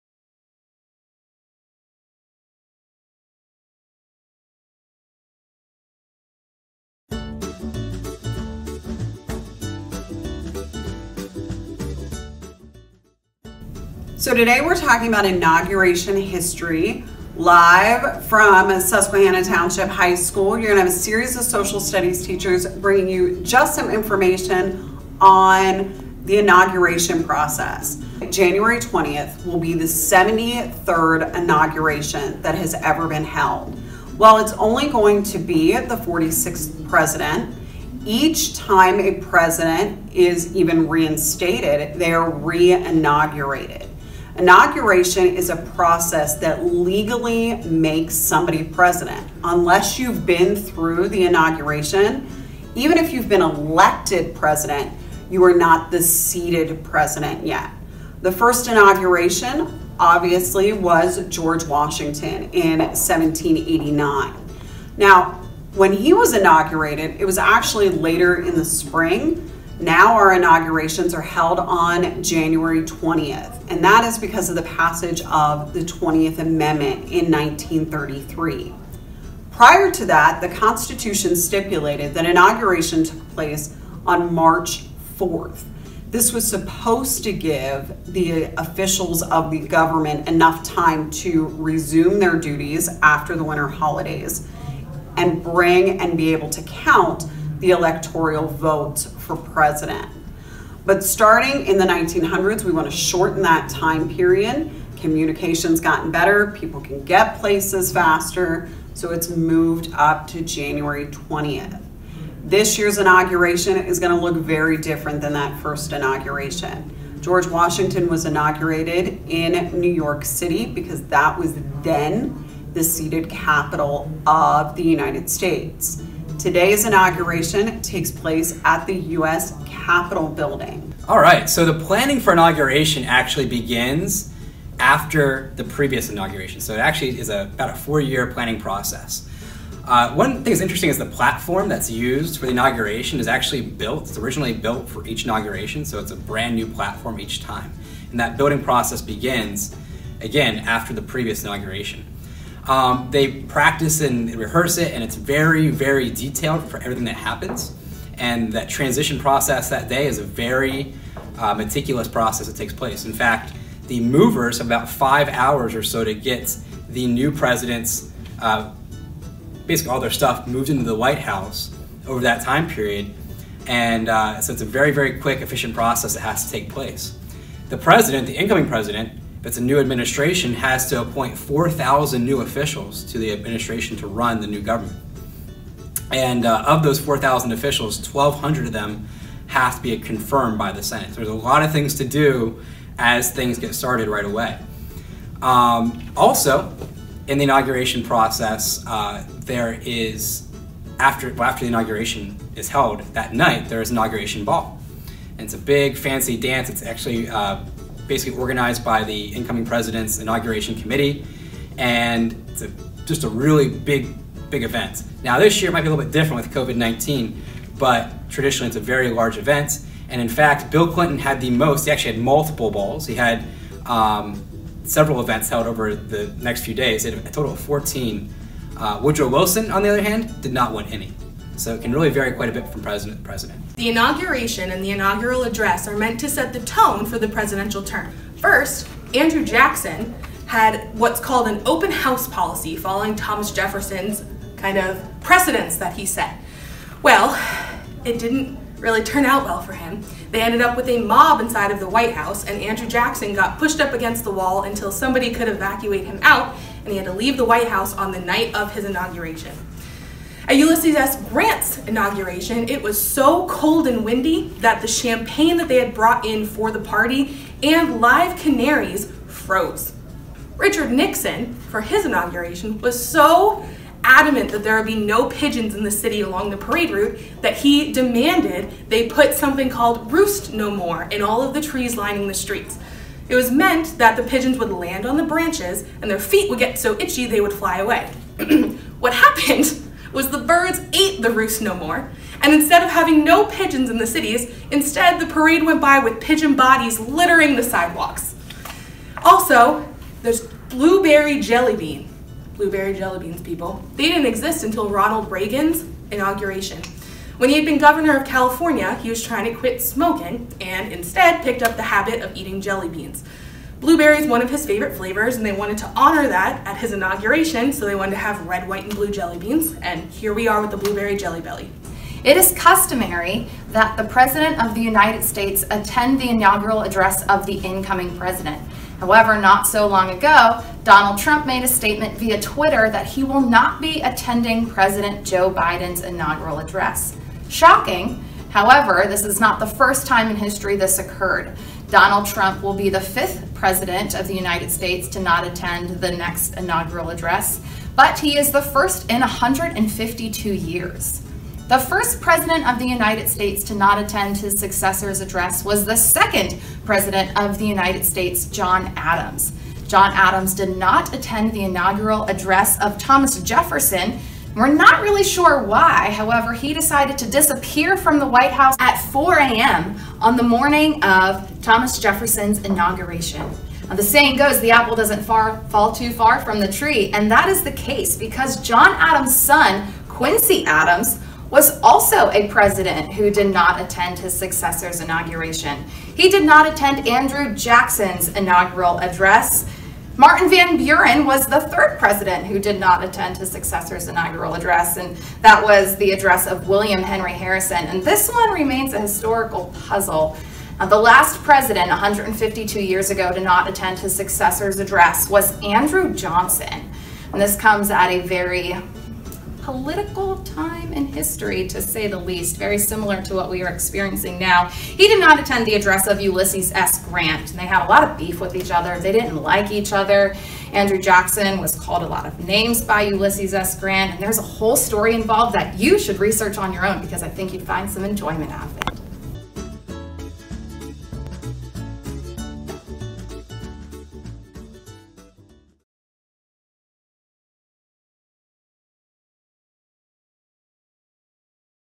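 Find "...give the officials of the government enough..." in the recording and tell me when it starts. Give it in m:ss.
1:27.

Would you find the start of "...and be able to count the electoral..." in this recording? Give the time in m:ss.
1:35.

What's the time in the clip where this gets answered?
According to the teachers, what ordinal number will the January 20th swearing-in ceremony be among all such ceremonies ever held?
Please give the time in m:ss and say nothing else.
0:29.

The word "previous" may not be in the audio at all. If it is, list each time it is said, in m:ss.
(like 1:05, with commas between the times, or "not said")
2:15, 2:31.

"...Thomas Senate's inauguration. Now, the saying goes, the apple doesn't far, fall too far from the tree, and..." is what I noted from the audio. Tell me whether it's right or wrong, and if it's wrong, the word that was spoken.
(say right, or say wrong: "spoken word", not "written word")
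wrong: "Jefferson", not "Senate".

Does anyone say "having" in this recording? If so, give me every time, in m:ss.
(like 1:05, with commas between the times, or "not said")
4:52.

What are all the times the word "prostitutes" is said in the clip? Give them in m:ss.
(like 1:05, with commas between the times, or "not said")
not said.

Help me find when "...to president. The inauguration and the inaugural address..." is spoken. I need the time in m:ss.
3:53.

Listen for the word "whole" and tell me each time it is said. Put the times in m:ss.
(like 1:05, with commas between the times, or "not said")
7:04.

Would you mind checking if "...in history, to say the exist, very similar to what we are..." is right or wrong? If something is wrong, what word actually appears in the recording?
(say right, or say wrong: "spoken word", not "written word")
wrong: "least", not "exist".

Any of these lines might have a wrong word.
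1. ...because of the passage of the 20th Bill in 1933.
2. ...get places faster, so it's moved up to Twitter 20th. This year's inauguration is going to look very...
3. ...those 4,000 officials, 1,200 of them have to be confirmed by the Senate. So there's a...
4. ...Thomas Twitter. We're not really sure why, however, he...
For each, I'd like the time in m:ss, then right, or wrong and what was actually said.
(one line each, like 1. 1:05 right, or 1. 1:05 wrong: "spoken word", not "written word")
1. 1:14 wrong: "Amendment", not "Bill"
2. 1:47 wrong: "January", not "Twitter"
3. 3:06 right
4. 6:02 wrong: "Jefferson", not "Twitter".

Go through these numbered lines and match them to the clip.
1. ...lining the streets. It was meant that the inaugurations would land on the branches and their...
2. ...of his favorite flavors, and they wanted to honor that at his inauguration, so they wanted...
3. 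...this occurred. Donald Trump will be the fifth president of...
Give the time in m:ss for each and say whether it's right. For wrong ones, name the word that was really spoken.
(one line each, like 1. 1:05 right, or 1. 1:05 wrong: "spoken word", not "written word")
1. 4:41 wrong: "pigeons", not "inaugurations"
2. 5:14 right
3. 5:40 right.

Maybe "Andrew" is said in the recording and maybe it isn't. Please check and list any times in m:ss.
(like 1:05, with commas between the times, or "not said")
3:59, 4:12, 6:27, 6:45, 7:00.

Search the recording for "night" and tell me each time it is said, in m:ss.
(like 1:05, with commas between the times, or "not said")
3:23, 4:18.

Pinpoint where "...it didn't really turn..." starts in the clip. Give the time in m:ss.
4:08.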